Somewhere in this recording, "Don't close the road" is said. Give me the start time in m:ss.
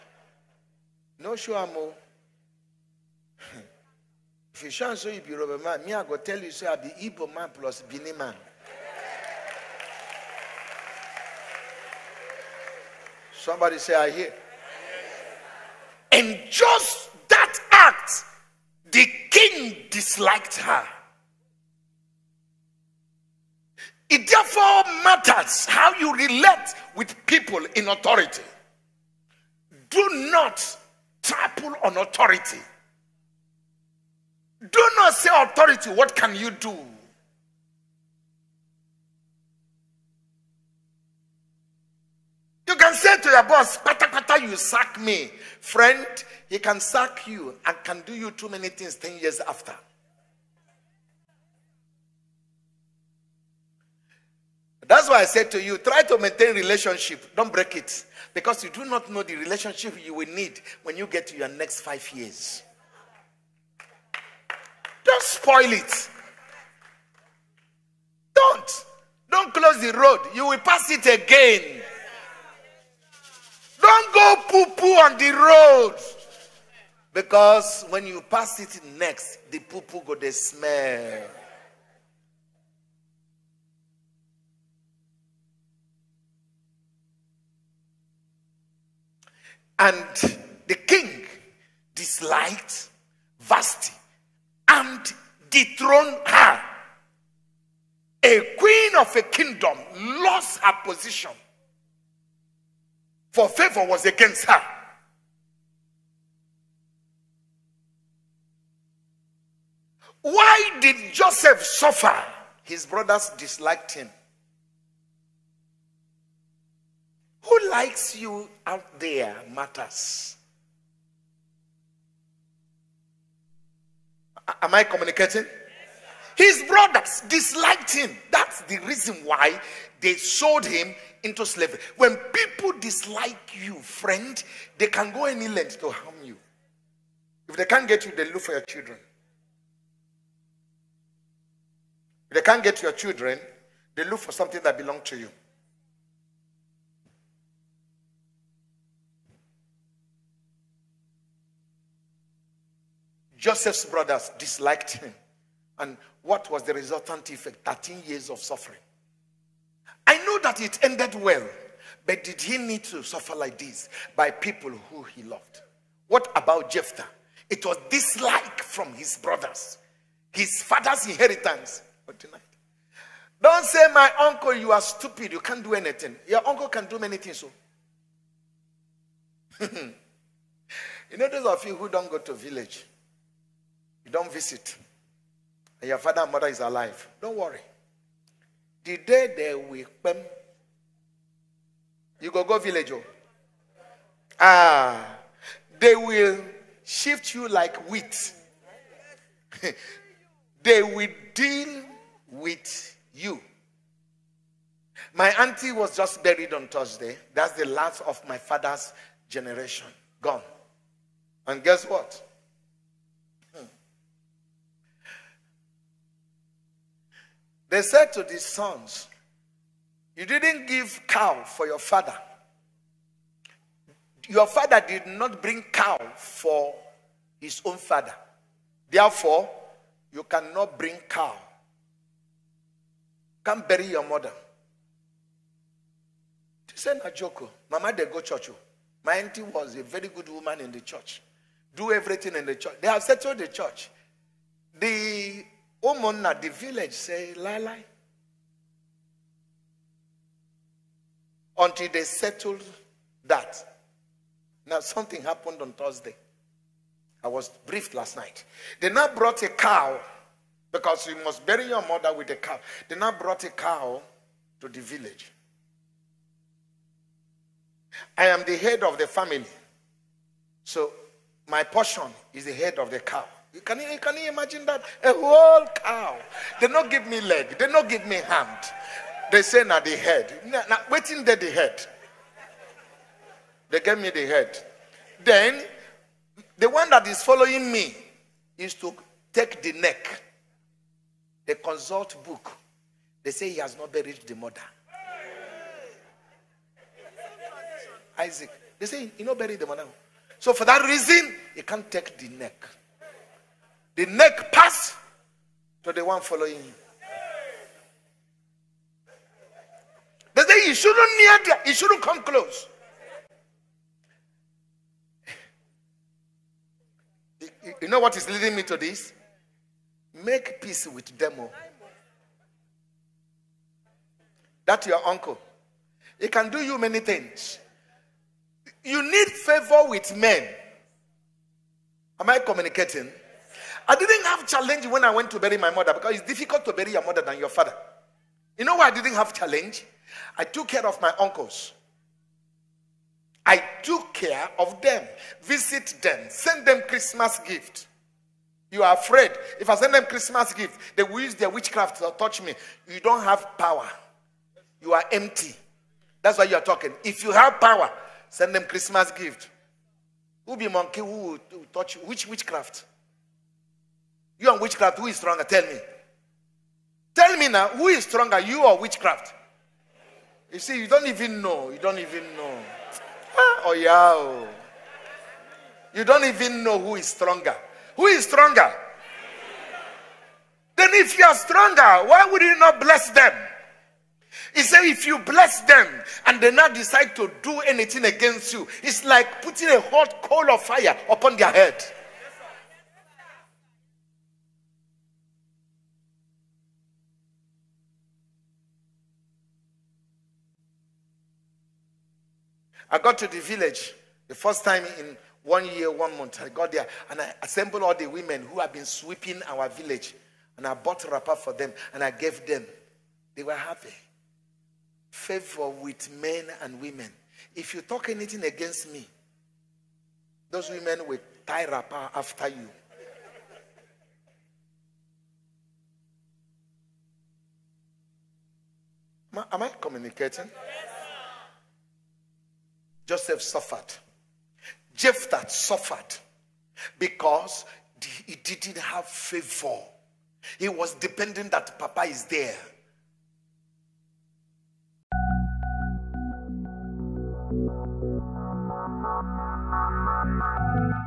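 1:09.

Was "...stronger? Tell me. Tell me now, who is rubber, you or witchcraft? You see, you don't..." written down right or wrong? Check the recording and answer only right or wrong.
wrong.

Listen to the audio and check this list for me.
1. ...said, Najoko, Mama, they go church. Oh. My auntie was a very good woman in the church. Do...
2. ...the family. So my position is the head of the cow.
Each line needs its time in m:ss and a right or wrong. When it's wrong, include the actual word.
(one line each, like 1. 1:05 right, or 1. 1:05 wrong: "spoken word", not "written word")
1. 3:56 right
2. 4:28 wrong: "portion", not "position".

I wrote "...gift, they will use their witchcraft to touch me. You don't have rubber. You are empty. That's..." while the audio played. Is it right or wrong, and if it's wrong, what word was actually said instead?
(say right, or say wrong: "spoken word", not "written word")
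wrong: "power", not "rubber".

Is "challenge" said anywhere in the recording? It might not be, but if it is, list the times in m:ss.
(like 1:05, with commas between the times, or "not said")
5:34, 5:39.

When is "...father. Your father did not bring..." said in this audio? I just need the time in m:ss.
3:41.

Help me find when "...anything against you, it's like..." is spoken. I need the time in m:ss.
6:27.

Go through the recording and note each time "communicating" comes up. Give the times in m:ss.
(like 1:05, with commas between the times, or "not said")
2:04, 5:32, 7:09.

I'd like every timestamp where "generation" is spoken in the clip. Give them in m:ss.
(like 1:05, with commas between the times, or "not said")
3:29.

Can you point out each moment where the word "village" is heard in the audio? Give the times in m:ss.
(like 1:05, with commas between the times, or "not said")
3:02, 3:12, 4:06, 4:24, 6:43, 6:49.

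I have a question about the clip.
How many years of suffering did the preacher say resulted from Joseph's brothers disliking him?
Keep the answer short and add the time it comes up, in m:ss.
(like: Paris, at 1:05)
13 years, at 2:37.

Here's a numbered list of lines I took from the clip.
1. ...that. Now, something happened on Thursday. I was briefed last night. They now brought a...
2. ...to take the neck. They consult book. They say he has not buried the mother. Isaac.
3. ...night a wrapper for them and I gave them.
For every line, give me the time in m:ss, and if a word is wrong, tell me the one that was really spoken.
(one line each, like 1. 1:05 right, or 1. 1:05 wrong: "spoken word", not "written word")
1. 4:13 right
2. 4:48 right
3. 6:50 wrong: "bought", not "night".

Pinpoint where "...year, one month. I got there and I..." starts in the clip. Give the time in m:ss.
6:45.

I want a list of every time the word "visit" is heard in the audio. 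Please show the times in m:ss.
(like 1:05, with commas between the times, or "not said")
3:04, 5:45.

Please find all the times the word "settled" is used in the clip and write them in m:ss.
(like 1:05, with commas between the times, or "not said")
4:03, 4:12.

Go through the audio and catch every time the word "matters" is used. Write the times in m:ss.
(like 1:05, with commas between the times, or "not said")
0:25, 1:59.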